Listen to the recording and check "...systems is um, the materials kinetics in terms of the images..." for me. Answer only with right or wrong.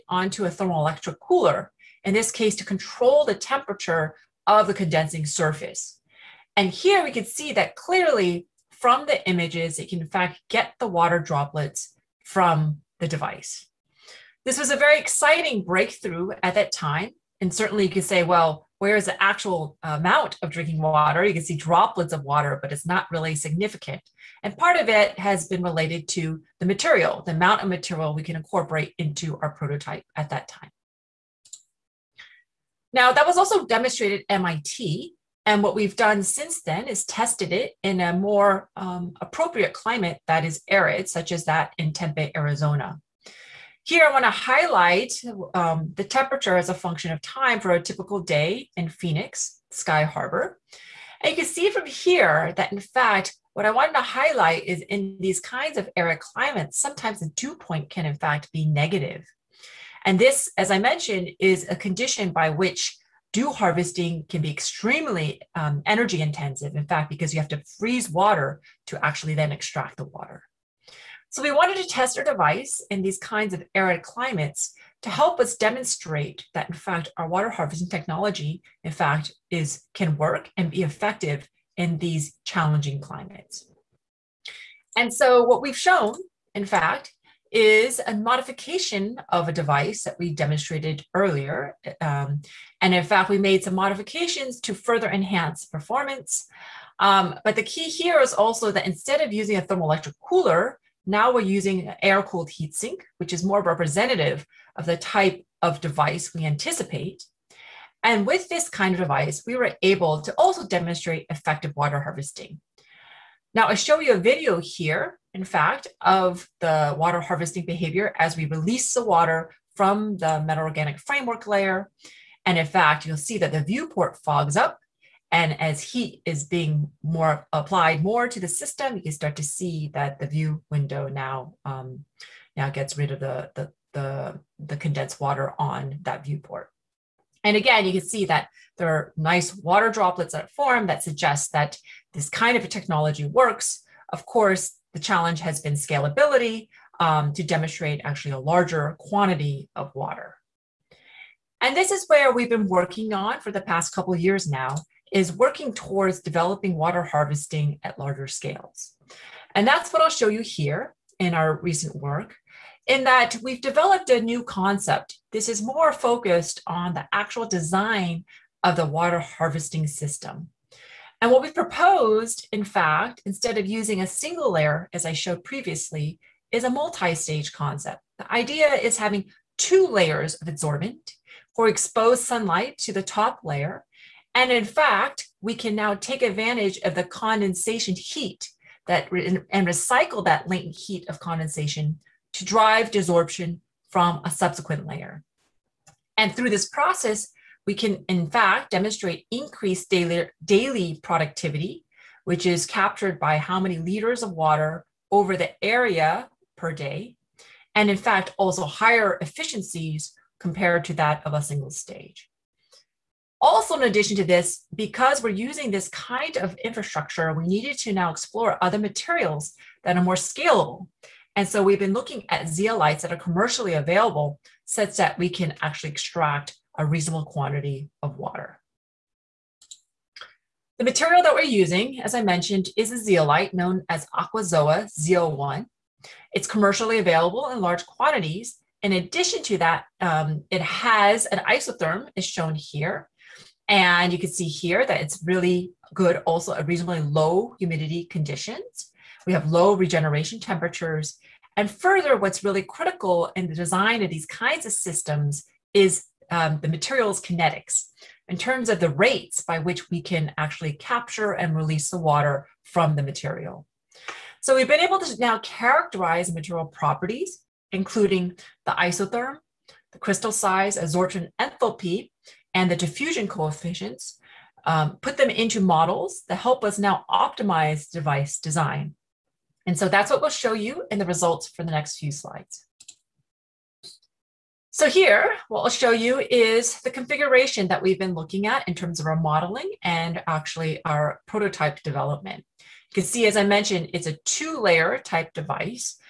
wrong.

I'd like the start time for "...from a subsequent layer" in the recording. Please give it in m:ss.
3:13.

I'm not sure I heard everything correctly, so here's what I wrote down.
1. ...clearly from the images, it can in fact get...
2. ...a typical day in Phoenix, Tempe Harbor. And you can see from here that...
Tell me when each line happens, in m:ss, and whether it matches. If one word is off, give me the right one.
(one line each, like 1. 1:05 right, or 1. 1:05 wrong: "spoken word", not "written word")
1. 0:07 right
2. 0:47 wrong: "Sky", not "Tempe".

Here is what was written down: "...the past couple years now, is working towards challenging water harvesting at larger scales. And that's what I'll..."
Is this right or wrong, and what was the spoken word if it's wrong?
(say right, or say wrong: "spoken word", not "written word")
wrong: "developing", not "challenging".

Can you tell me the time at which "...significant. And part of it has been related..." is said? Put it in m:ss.
0:23.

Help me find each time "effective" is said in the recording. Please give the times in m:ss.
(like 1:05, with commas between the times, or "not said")
1:20, 1:51.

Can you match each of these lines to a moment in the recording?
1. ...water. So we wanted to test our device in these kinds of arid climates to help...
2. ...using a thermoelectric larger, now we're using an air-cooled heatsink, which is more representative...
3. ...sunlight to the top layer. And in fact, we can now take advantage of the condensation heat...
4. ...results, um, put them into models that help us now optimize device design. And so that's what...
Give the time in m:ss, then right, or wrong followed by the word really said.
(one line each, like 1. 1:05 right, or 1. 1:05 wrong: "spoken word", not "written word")
1. 1:10 right
2. 1:39 wrong: "cooler", not "larger"
3. 3:02 right
4. 4:33 wrong: "coefficients", not "results".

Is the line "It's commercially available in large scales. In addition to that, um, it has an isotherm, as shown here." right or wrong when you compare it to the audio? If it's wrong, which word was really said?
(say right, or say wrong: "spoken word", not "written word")
wrong: "quantities", not "scales".